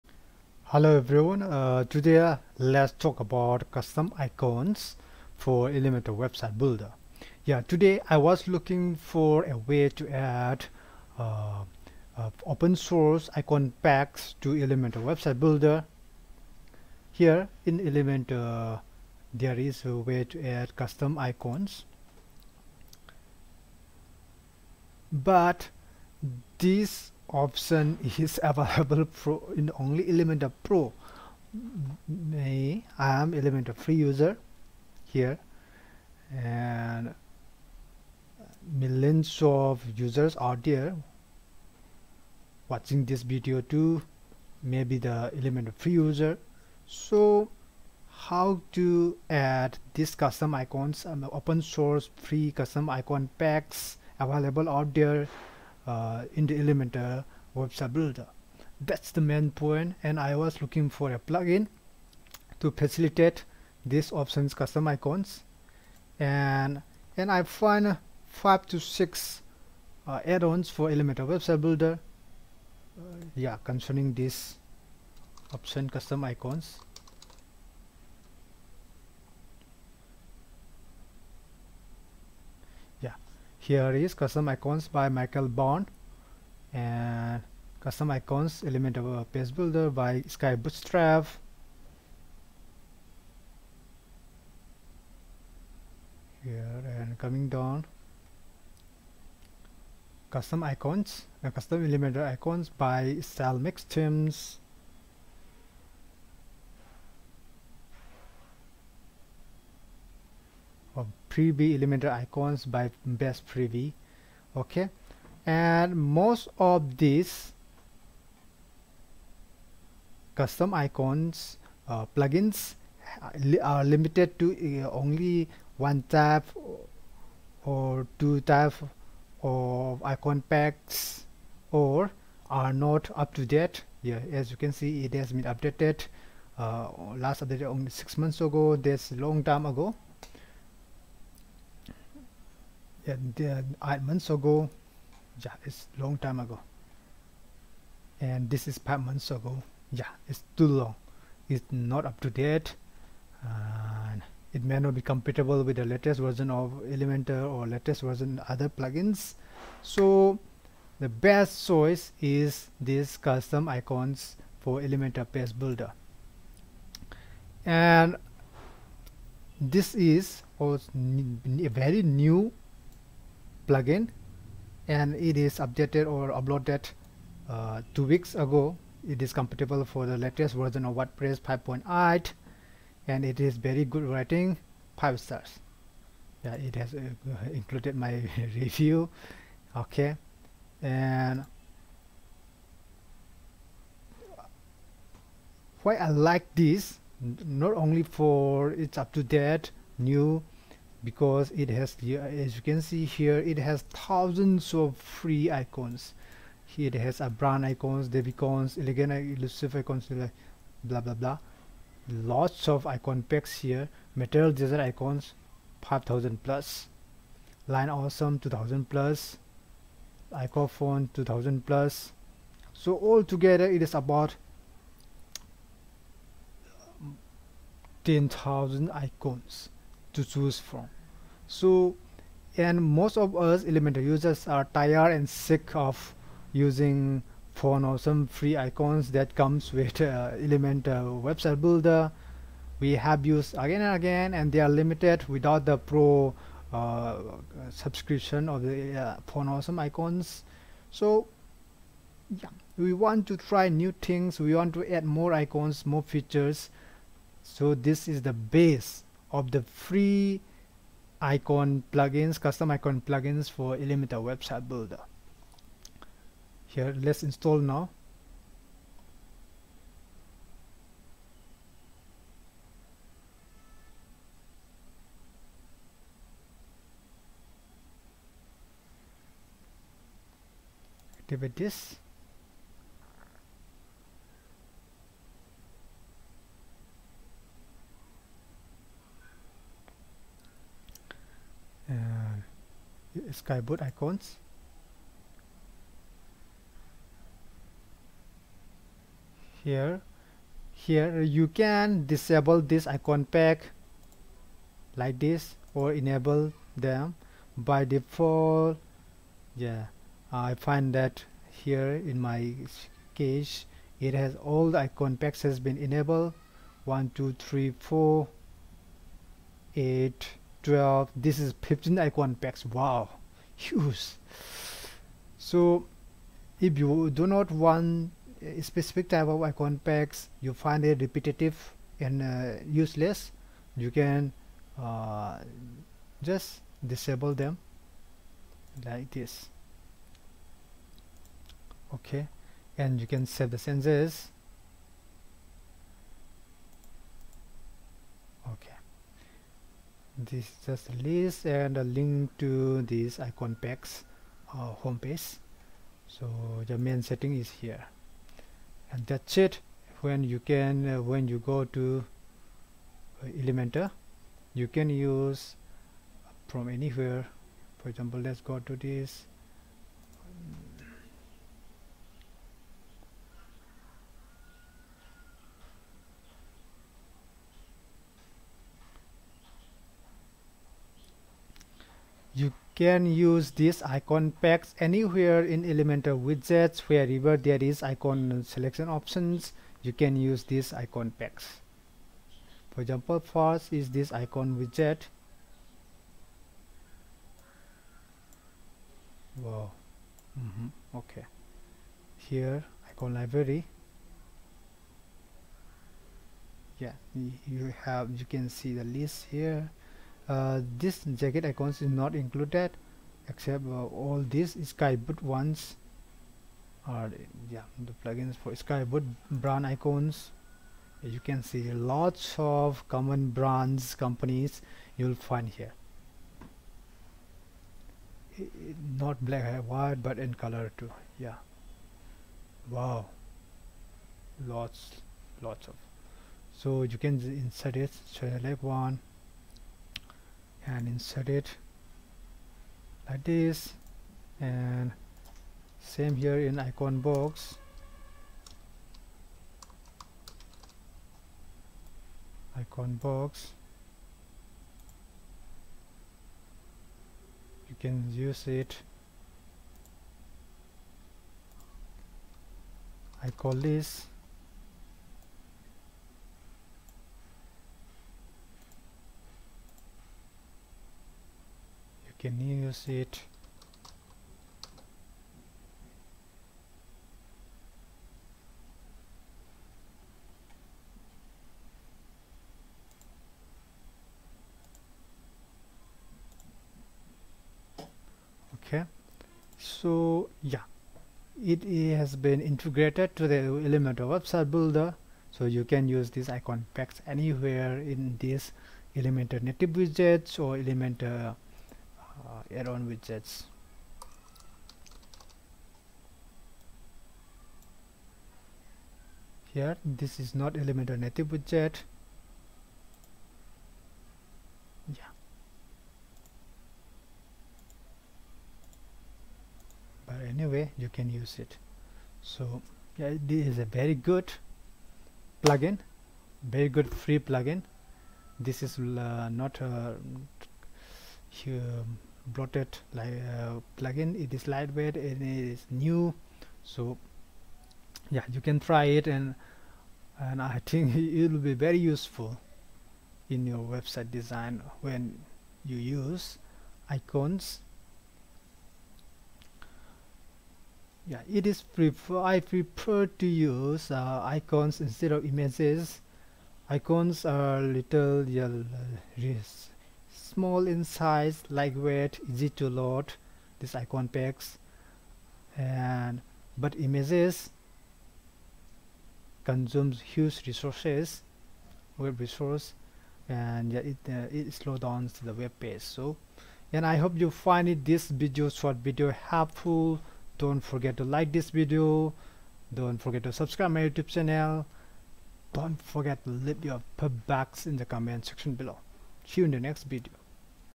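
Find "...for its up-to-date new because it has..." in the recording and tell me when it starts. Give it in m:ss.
3:18.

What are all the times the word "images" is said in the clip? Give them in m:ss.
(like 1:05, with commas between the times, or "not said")
9:15, 9:26.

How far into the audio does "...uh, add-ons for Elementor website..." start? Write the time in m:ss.
1:10.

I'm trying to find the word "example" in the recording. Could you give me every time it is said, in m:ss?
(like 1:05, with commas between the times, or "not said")
6:07, 6:32.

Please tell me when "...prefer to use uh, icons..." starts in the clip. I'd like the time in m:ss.
9:12.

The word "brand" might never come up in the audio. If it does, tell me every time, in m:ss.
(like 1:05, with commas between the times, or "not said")
3:27, 6:59, 7:03.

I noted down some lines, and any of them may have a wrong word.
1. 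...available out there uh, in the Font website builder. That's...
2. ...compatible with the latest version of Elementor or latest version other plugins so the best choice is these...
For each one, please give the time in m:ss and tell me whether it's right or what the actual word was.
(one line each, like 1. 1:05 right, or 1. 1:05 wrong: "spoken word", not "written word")
1. 0:54 wrong: "Elementor", not "Font"
2. 2:35 right.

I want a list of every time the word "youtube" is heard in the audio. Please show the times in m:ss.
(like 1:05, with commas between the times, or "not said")
9:43.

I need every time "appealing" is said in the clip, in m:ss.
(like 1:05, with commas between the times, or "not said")
not said.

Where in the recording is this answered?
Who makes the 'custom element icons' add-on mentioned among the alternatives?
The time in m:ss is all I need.
1:43.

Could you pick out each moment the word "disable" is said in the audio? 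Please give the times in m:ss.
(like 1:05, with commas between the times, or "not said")
5:02, 5:36.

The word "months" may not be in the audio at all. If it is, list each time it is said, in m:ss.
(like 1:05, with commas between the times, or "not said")
2:18, 2:23, 2:29.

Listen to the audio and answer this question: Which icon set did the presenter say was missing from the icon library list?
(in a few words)
jacket icons.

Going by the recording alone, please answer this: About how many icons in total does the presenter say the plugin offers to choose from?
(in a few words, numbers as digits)
10,000.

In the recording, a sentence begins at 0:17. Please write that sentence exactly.
Here in Elementor there is a way to add custom icons.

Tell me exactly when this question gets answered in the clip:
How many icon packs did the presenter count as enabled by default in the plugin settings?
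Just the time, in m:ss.
5:21.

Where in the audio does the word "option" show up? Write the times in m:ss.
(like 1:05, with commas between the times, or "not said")
0:27, 1:04, 1:15, 6:28.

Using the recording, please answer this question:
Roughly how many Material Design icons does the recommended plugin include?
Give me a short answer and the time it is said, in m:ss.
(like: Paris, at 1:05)
5000+, at 3:35.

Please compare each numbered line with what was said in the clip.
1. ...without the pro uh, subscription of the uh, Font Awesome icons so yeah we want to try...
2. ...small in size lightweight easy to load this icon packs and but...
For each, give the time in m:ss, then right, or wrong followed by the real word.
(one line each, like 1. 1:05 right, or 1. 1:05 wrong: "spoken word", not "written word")
1. 4:05 right
2. 9:20 right.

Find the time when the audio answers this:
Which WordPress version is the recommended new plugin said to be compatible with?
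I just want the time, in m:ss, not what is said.
3:01.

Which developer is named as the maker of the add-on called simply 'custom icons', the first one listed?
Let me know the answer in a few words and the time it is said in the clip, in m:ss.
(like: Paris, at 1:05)
Michael Bond, at 1:25.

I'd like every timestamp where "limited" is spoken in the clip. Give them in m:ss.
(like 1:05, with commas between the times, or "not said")
2:03, 4:04.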